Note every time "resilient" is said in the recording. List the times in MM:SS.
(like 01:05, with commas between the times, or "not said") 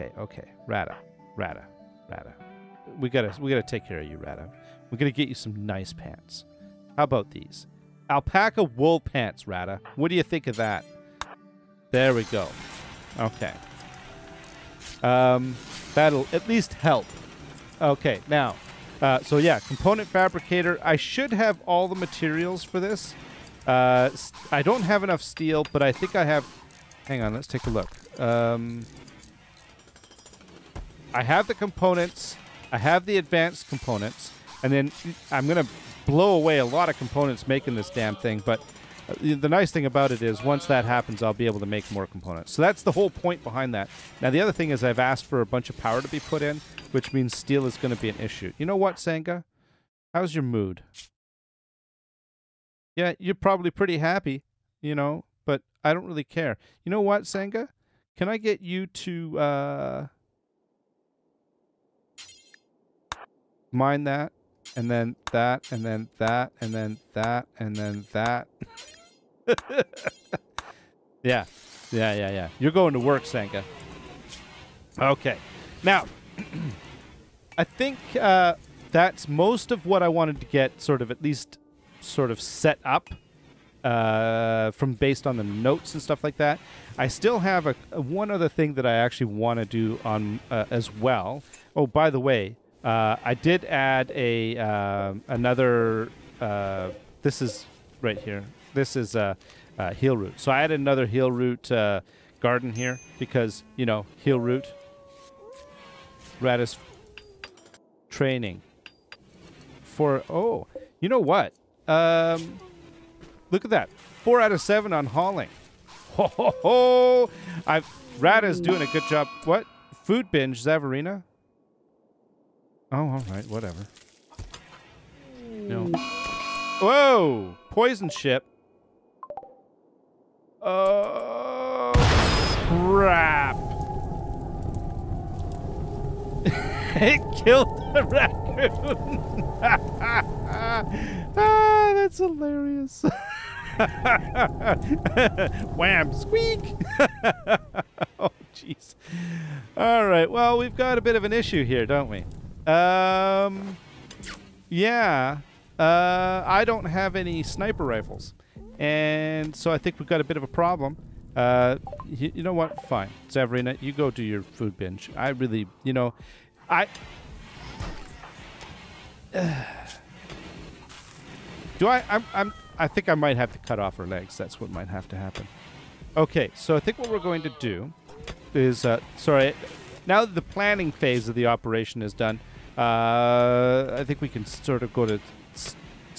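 not said.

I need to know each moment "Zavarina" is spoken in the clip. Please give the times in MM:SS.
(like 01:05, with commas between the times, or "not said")
02:00, 02:43.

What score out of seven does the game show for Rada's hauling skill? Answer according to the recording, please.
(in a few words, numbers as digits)
4.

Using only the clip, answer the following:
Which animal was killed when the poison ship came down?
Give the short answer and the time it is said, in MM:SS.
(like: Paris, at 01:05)
Raccoon, at 02:18.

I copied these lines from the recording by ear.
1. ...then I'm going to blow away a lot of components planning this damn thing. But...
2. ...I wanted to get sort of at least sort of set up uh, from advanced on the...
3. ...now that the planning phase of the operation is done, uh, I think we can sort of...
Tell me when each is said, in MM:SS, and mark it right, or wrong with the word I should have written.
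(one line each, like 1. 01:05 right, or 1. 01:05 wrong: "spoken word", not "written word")
1. 00:34 wrong: "making", not "planning"
2. 01:20 wrong: "based", not "advanced"
3. 03:00 right.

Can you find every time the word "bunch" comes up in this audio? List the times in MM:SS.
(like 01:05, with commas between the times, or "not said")
00:45.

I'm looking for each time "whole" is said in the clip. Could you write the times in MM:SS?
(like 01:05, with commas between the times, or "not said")
00:42.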